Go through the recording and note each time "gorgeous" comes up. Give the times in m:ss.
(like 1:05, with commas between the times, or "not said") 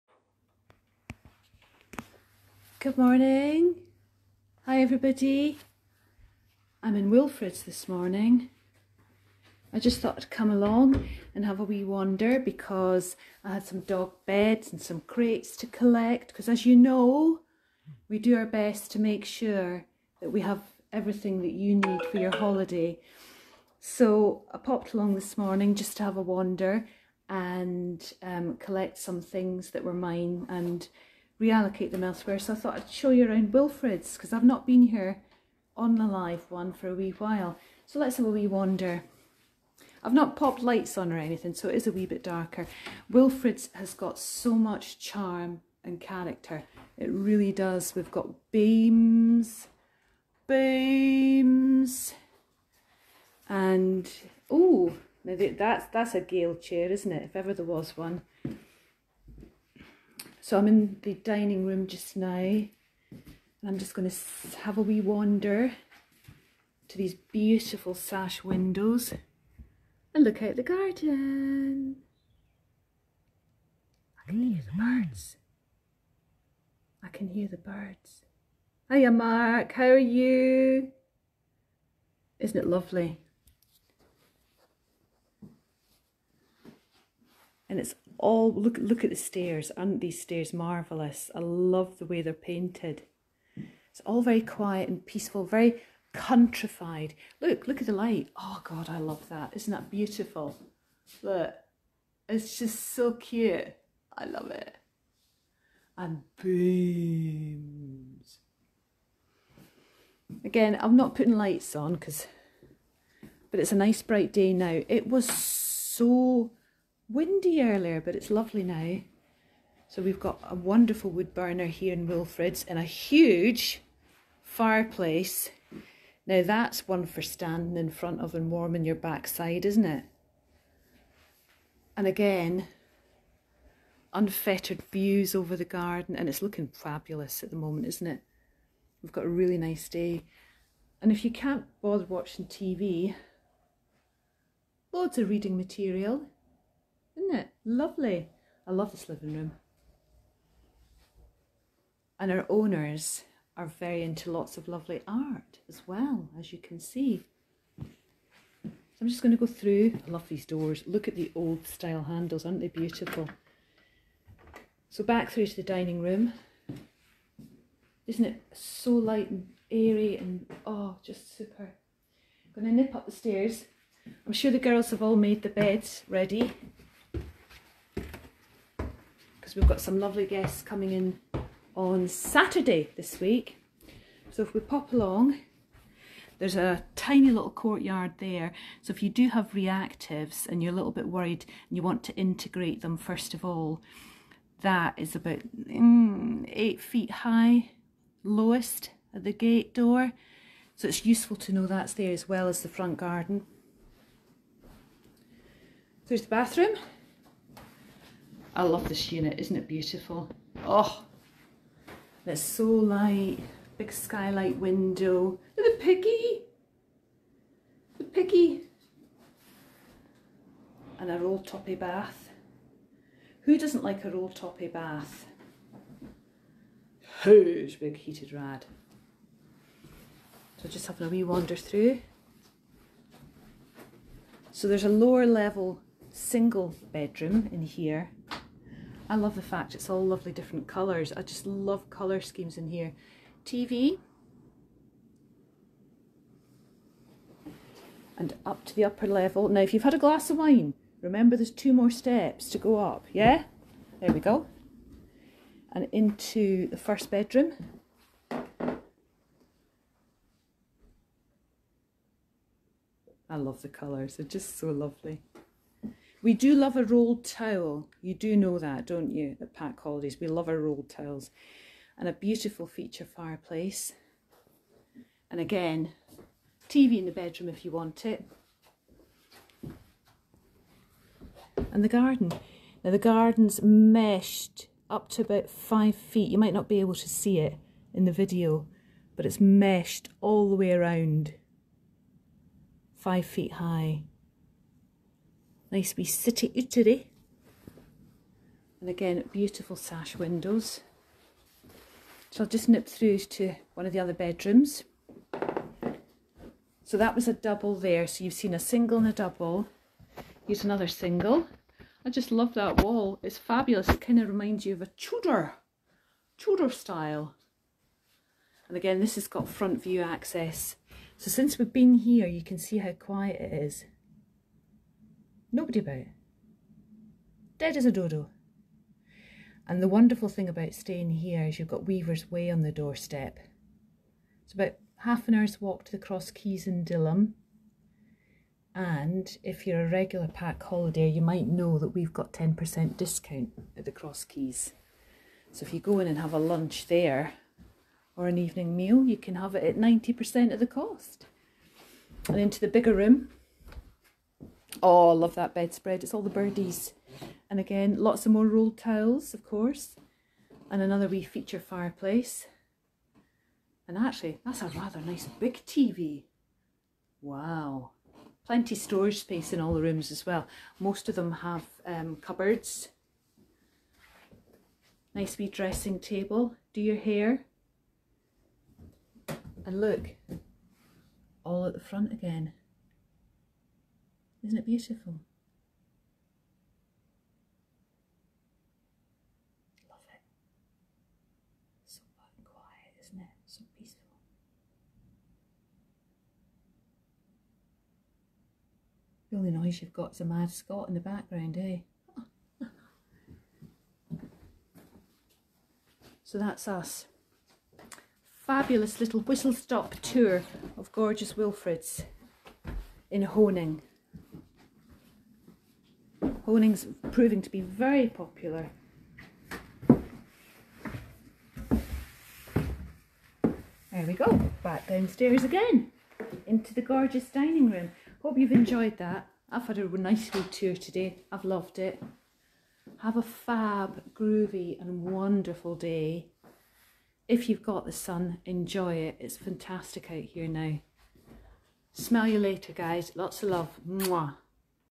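6:50, 7:06.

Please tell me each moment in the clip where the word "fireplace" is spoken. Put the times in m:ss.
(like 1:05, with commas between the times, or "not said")
2:04, 4:33, 6:01.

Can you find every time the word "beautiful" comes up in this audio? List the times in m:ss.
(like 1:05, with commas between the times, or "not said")
1:07, 1:39, 2:42, 3:29, 4:32, 4:59, 6:24.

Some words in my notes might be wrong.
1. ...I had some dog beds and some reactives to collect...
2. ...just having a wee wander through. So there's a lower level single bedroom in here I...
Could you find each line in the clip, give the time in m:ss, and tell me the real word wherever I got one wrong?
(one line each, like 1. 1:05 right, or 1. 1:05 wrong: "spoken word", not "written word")
1. 0:13 wrong: "crates", not "reactives"
2. 3:50 right.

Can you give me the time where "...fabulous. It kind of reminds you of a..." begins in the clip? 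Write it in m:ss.
5:13.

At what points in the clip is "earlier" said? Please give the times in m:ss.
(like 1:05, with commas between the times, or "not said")
1:57.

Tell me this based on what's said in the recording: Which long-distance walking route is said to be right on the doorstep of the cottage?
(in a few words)
Weaver's Way.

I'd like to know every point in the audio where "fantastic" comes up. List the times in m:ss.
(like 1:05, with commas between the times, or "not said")
7:19.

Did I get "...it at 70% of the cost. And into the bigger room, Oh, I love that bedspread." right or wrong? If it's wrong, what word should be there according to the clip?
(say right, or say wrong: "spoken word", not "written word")
wrong: "90", not "70".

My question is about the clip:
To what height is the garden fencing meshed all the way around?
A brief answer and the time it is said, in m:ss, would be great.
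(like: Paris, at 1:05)
5 feet, at 4:52.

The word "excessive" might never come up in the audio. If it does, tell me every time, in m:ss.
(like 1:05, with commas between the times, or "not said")
not said.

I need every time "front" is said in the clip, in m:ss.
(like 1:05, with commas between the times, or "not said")
2:07, 3:22, 5:19, 6:21.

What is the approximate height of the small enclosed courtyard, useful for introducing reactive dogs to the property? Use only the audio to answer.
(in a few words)
8 feet.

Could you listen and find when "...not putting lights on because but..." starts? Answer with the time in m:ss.
1:50.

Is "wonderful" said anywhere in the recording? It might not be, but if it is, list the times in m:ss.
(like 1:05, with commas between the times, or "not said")
2:00, 5:29, 7:15.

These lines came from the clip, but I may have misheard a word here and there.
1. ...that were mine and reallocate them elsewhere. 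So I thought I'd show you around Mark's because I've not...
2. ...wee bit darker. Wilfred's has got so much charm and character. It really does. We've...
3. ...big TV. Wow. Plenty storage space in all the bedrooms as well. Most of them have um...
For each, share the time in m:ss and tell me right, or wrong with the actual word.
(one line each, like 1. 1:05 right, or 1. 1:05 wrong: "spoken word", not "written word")
1. 0:29 wrong: "Wilfred", not "Mark"
2. 0:41 right
3. 6:05 wrong: "rooms", not "bedrooms".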